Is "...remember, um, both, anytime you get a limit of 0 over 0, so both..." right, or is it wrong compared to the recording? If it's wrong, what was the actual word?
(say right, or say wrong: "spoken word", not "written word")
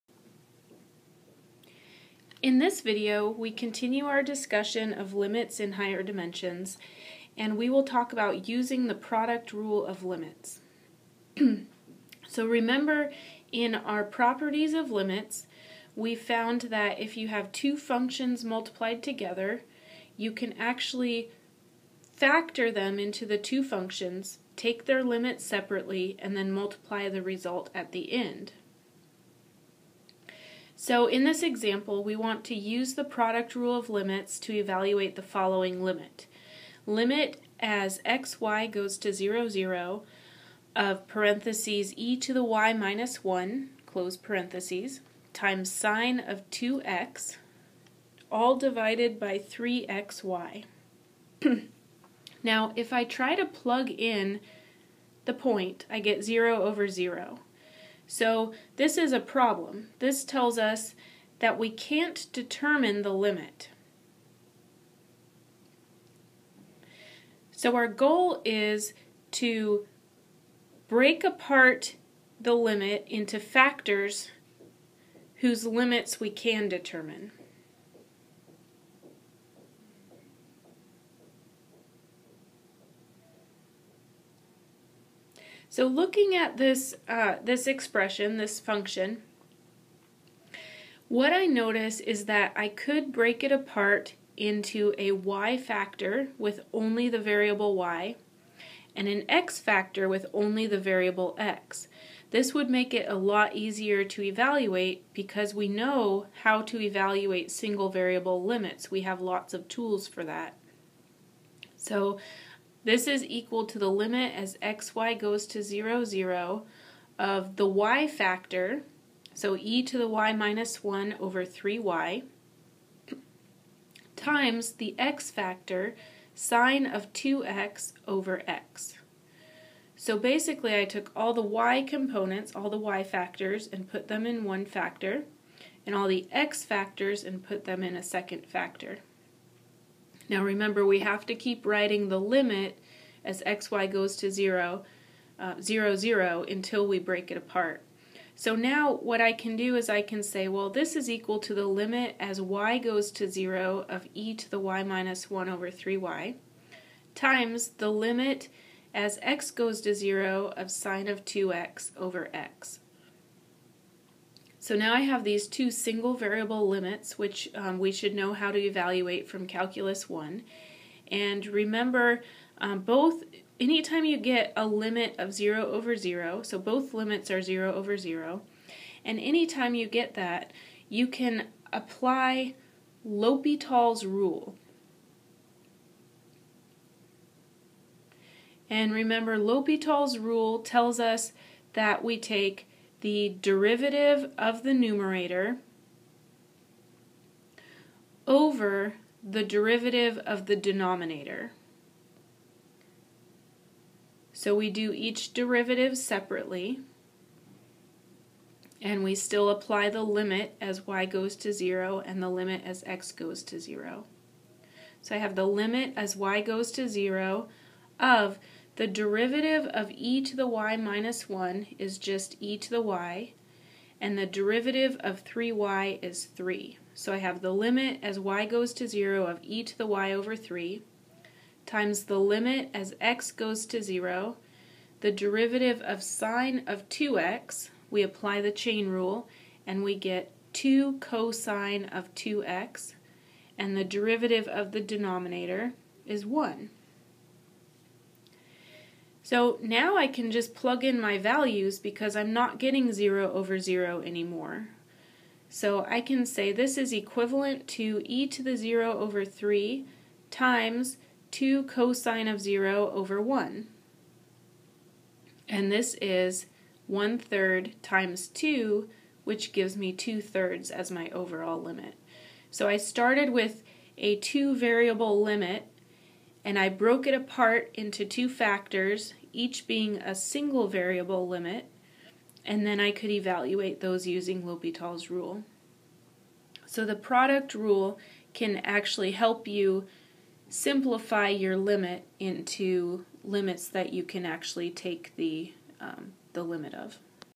right.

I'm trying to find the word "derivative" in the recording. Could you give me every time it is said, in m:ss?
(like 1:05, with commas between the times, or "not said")
3:13, 3:19, 3:25, 3:38, 3:44, 3:55, 4:03.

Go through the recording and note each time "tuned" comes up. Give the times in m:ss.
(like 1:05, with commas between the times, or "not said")
not said.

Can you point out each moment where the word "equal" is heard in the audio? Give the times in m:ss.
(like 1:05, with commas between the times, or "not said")
1:53, 2:31.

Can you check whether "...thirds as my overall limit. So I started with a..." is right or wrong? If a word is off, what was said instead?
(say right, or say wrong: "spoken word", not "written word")
right.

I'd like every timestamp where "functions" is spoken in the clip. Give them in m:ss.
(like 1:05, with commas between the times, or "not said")
0:17, 0:23, 1:28.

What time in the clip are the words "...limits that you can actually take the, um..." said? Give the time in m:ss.
4:53.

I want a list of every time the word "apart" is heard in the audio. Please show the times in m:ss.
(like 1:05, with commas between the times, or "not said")
1:11, 1:33, 2:27, 4:37.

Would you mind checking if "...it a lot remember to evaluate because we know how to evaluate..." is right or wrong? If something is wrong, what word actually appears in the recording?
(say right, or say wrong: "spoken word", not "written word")
wrong: "easier", not "remember".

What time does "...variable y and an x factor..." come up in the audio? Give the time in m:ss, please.
1:37.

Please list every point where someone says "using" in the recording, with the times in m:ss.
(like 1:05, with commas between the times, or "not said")
0:08, 4:44.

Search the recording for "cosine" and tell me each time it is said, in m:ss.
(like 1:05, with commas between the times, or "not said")
4:00, 4:21.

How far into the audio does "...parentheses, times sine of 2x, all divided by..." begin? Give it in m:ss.
0:44.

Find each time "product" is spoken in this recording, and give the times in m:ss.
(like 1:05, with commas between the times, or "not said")
0:08, 0:33, 4:46.